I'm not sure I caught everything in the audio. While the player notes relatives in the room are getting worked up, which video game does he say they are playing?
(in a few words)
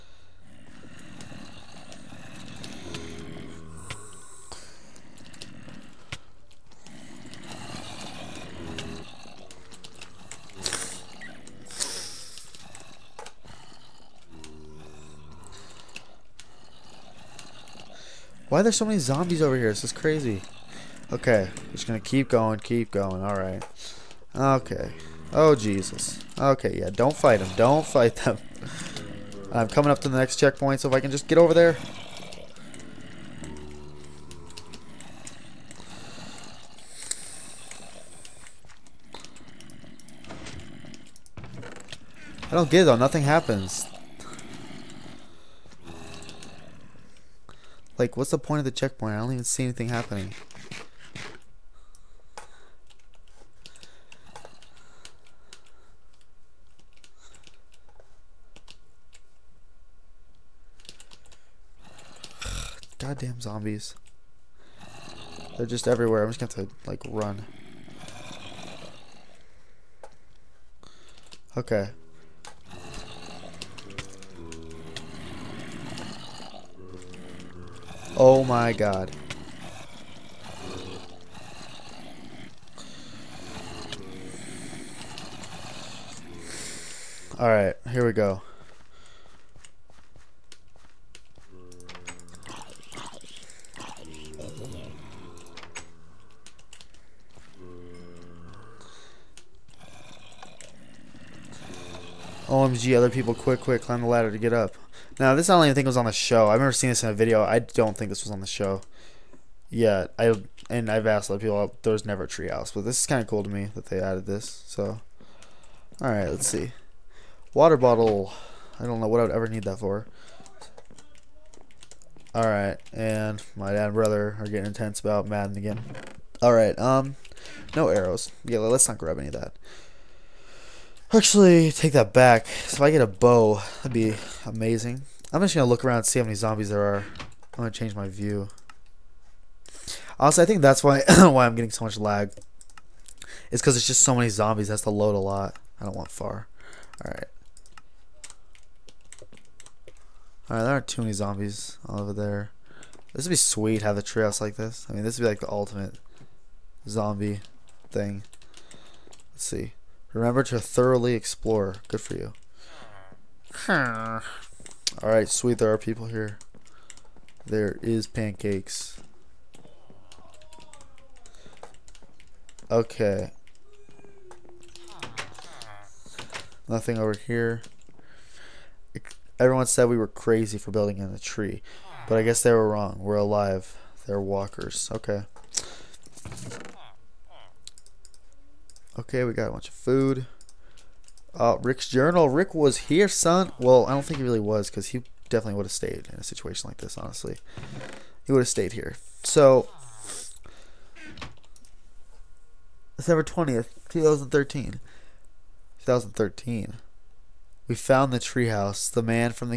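Madden.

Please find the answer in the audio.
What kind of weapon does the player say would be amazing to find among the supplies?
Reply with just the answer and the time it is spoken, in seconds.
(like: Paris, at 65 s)
A bow, at 132 s.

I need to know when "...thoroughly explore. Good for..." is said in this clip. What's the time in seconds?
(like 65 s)
160 s.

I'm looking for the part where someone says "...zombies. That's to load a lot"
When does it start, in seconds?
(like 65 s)
144 s.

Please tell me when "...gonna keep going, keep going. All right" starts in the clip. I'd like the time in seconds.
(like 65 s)
21 s.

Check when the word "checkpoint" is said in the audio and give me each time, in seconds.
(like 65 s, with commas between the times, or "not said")
30 s, 48 s.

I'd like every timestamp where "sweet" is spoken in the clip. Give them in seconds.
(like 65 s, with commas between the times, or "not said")
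153 s, 165 s.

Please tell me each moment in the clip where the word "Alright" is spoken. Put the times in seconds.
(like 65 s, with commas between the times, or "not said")
87 s, 163 s.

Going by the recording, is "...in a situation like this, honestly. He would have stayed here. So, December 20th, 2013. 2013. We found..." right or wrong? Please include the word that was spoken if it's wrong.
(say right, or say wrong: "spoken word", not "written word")
right.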